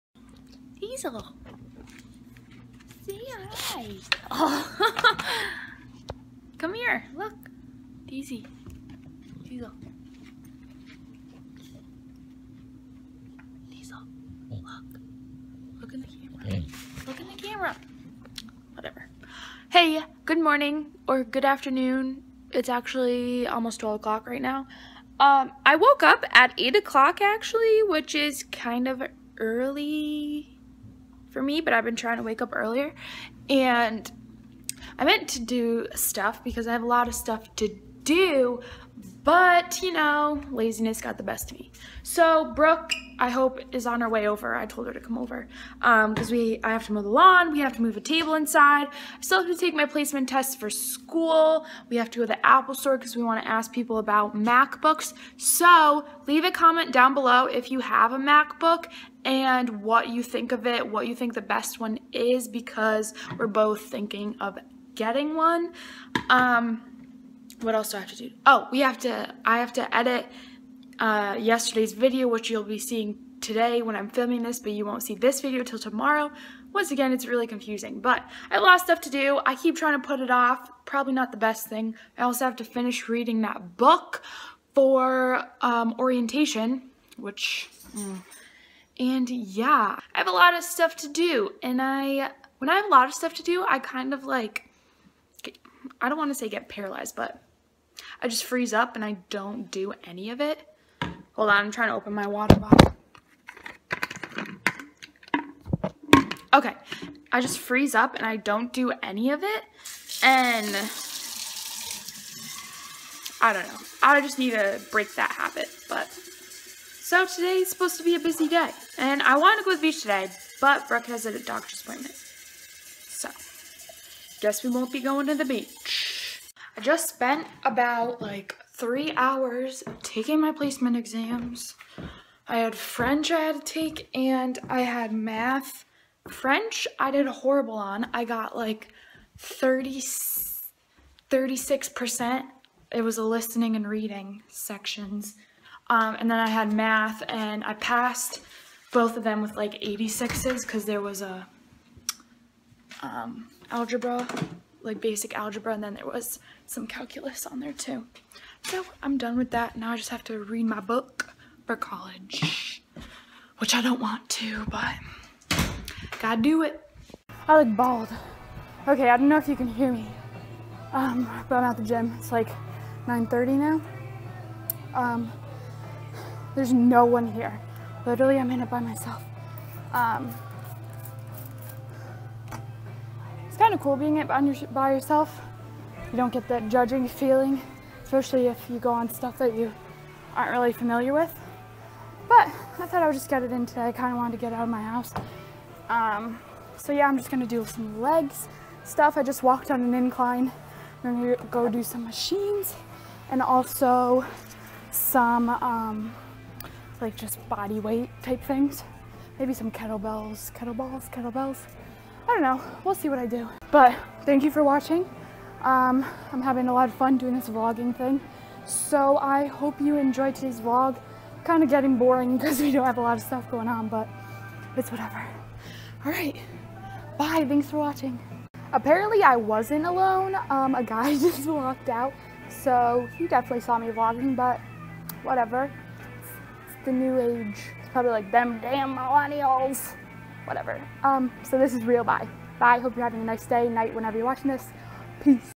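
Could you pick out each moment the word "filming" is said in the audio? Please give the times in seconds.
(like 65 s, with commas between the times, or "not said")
74 s.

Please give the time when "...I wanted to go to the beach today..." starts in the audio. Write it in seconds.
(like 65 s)
119 s.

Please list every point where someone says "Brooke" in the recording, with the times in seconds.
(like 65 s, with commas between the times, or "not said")
42 s, 120 s.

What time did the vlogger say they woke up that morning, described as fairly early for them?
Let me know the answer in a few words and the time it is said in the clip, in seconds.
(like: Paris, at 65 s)
8 o'clock, at 26 s.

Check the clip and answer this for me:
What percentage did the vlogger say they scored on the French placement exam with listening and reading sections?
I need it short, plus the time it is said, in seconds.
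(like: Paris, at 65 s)
36%, at 141 s.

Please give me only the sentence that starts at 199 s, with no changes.
I just walked on an incline.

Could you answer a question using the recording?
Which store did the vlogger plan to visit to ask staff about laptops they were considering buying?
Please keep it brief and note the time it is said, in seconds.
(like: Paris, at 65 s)
Apple store, at 52 s.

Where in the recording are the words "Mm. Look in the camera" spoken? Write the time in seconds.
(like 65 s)
16 s.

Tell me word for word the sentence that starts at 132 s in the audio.
I had French I had to take and I had math.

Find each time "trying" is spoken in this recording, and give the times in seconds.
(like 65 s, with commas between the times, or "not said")
31 s, 79 s, 101 s.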